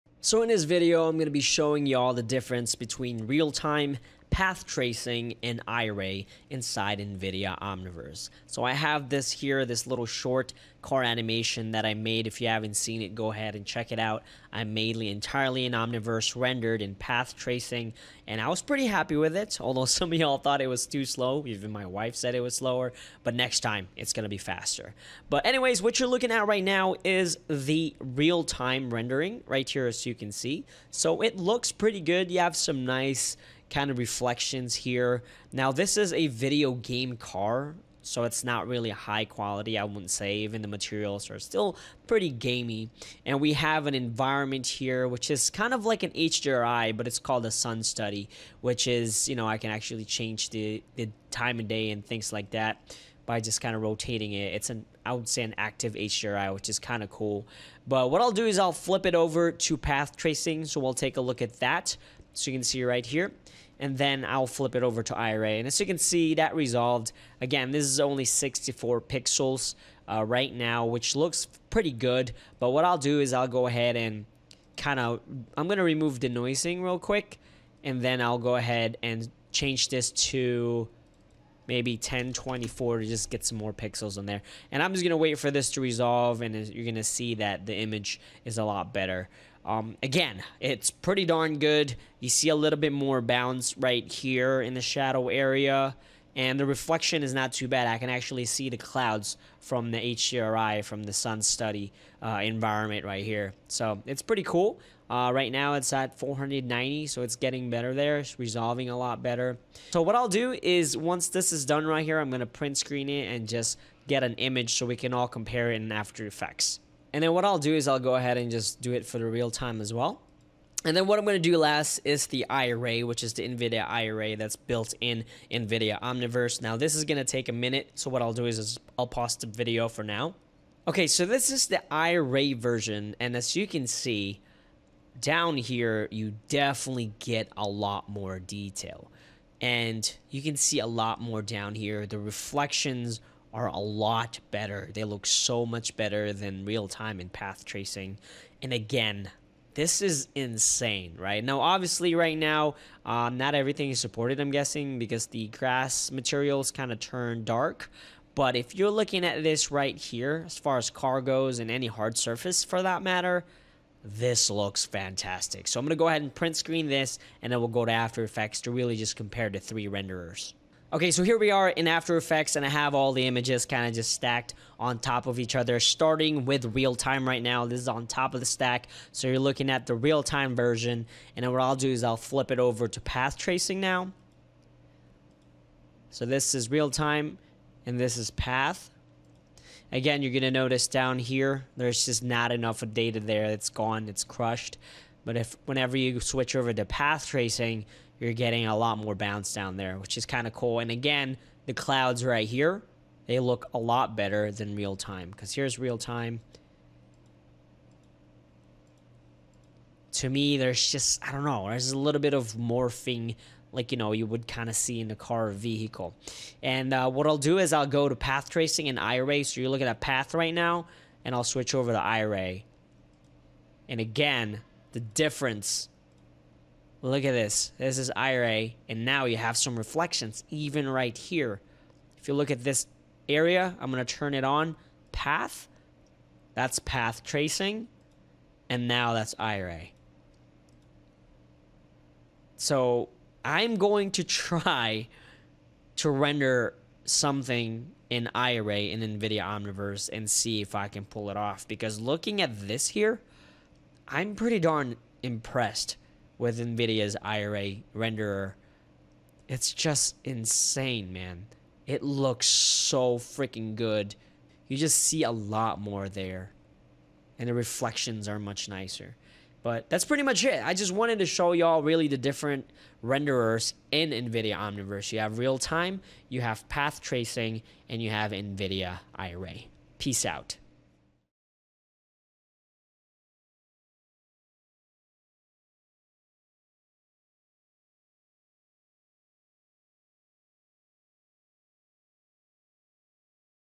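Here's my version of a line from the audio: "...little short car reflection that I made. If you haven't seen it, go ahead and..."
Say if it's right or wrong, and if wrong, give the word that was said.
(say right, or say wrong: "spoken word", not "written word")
wrong: "animation", not "reflection".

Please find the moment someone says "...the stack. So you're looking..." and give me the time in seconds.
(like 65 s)
178 s.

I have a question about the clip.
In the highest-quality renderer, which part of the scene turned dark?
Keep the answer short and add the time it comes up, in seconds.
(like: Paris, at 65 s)
grass materials, at 155 s.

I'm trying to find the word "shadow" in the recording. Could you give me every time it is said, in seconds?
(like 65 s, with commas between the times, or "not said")
94 s.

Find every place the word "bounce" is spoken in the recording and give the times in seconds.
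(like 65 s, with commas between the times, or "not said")
93 s, 199 s.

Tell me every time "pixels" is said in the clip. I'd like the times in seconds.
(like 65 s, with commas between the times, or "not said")
69 s, 83 s.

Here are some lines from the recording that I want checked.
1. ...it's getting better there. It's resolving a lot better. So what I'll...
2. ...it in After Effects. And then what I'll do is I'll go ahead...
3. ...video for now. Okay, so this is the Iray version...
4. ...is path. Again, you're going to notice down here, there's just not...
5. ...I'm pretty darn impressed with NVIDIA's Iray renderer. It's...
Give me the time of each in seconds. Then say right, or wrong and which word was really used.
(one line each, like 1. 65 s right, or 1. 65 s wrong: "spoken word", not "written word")
1. 107 s right
2. 115 s right
3. 129 s right
4. 188 s right
5. 254 s right.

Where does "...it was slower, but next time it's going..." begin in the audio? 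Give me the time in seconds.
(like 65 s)
22 s.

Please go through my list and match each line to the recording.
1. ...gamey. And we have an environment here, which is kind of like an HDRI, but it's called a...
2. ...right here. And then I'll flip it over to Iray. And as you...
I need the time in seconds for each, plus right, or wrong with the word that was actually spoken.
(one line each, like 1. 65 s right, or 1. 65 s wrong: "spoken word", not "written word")
1. 42 s right
2. 62 s right.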